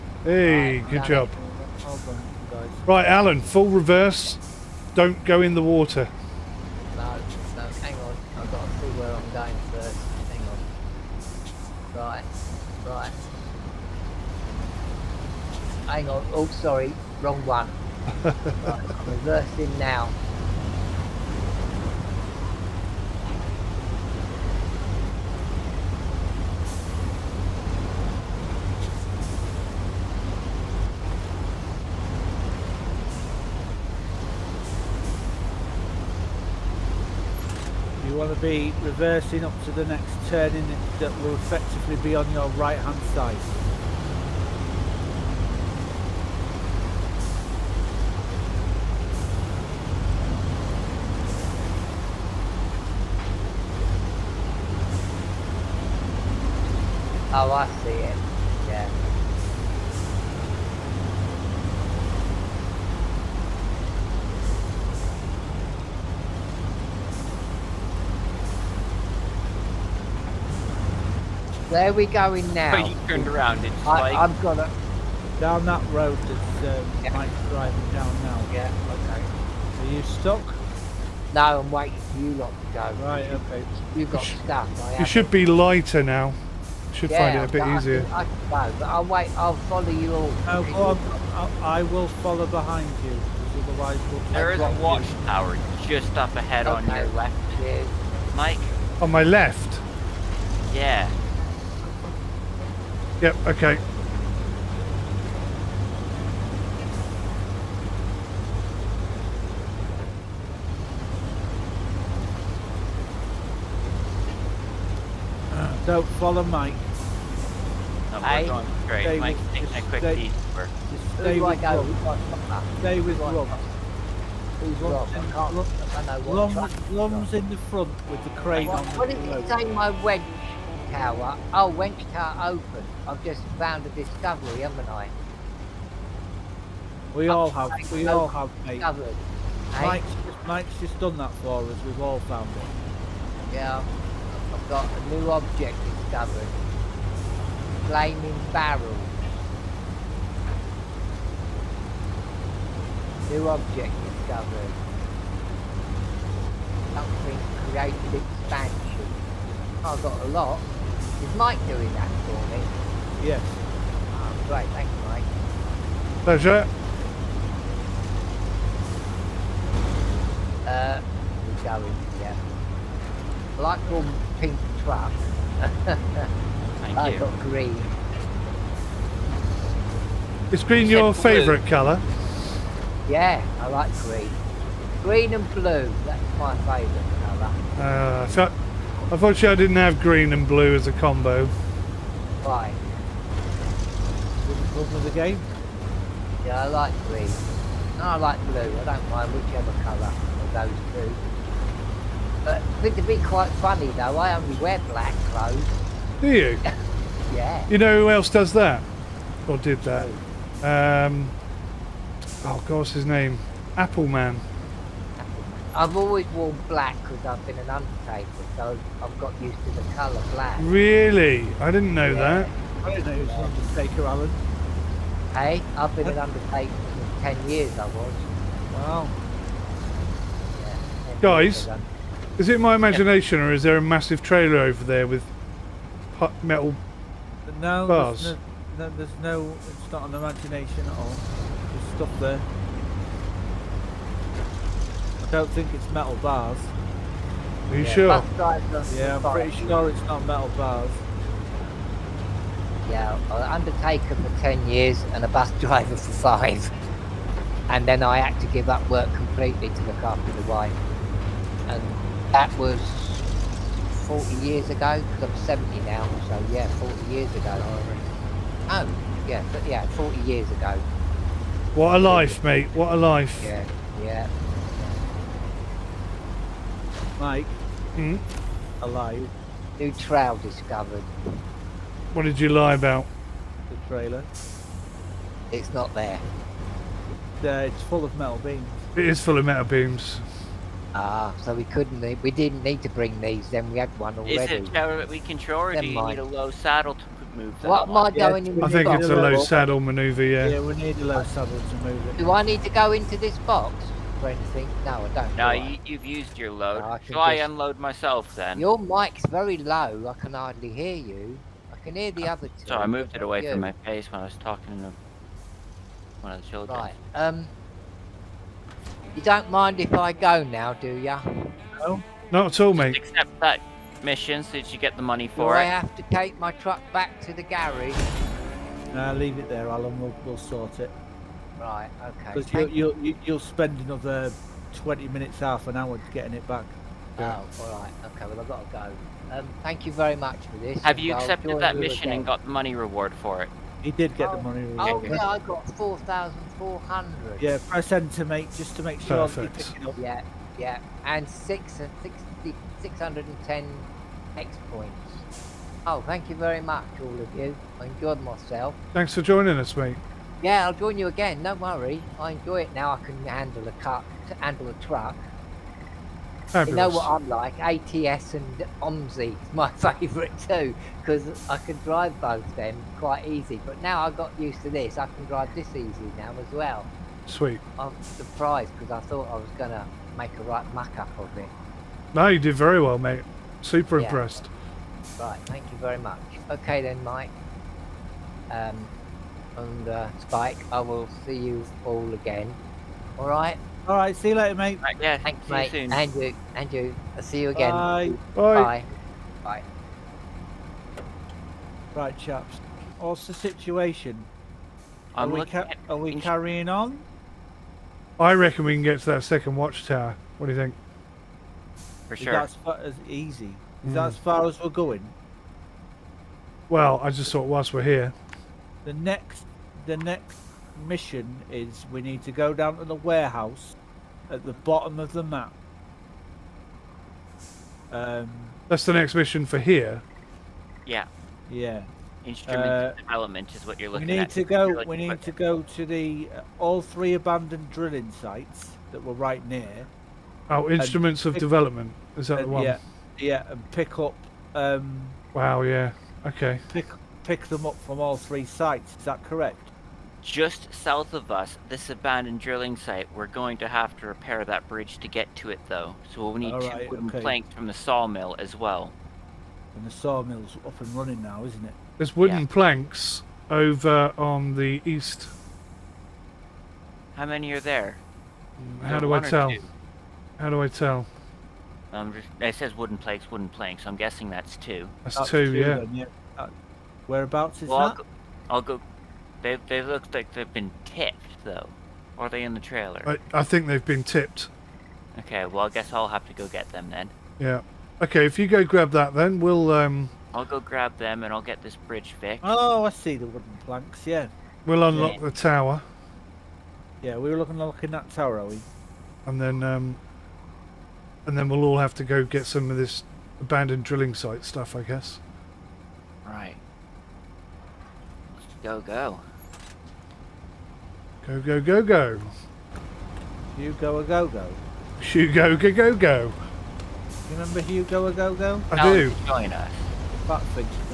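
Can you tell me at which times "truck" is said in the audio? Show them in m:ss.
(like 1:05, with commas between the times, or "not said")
2:54, 5:26, 6:04.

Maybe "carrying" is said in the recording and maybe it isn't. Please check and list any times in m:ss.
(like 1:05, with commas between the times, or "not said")
6:46.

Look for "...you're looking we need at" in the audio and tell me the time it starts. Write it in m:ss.
7:13.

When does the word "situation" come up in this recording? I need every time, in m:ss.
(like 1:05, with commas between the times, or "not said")
6:43.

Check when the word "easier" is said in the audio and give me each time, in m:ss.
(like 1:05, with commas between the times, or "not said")
1:27.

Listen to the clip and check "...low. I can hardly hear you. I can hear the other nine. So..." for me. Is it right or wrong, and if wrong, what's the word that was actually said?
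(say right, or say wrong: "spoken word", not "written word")
wrong: "two", not "nine".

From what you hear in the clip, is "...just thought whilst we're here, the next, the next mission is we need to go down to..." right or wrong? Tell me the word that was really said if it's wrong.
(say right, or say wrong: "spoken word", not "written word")
right.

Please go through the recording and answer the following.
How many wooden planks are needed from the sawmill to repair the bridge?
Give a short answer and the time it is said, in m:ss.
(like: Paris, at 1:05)
2, at 7:36.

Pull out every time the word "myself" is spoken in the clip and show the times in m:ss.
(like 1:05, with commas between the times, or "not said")
5:07, 5:58.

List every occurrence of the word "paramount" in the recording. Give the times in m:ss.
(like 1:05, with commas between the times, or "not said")
not said.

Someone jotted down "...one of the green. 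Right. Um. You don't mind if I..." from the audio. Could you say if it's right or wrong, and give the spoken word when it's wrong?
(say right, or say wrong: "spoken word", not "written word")
wrong: "children", not "green".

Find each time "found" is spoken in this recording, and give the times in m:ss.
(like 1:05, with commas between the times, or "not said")
2:13, 2:22.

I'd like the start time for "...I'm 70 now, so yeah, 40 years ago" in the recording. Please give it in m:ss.
4:25.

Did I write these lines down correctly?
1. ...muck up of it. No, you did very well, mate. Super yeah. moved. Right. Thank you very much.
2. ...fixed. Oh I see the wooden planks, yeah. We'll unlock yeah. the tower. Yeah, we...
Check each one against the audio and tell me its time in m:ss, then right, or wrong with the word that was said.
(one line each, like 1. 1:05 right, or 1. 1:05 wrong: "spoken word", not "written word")
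1. 6:20 wrong: "impressed", not "moved"
2. 8:12 right.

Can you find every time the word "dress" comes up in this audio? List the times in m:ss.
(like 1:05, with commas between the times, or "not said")
not said.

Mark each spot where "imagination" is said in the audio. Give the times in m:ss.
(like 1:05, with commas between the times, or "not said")
3:52, 4:00.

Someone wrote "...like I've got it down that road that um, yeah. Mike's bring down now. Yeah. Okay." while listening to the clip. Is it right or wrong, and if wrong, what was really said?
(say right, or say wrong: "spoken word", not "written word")
wrong: "driving", not "bring".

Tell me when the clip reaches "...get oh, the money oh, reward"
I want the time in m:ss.
5:44.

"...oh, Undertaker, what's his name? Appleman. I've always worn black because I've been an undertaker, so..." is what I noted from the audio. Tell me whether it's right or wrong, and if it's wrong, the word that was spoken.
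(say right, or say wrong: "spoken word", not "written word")
wrong: "God", not "Undertaker".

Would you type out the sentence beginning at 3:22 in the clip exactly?
But it would be quite funny though, I only wear black clothes.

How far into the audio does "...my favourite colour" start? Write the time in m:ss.
3:06.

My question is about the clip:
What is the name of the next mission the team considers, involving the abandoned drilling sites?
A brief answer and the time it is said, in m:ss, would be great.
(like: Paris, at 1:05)
Instruments of development, at 7:20.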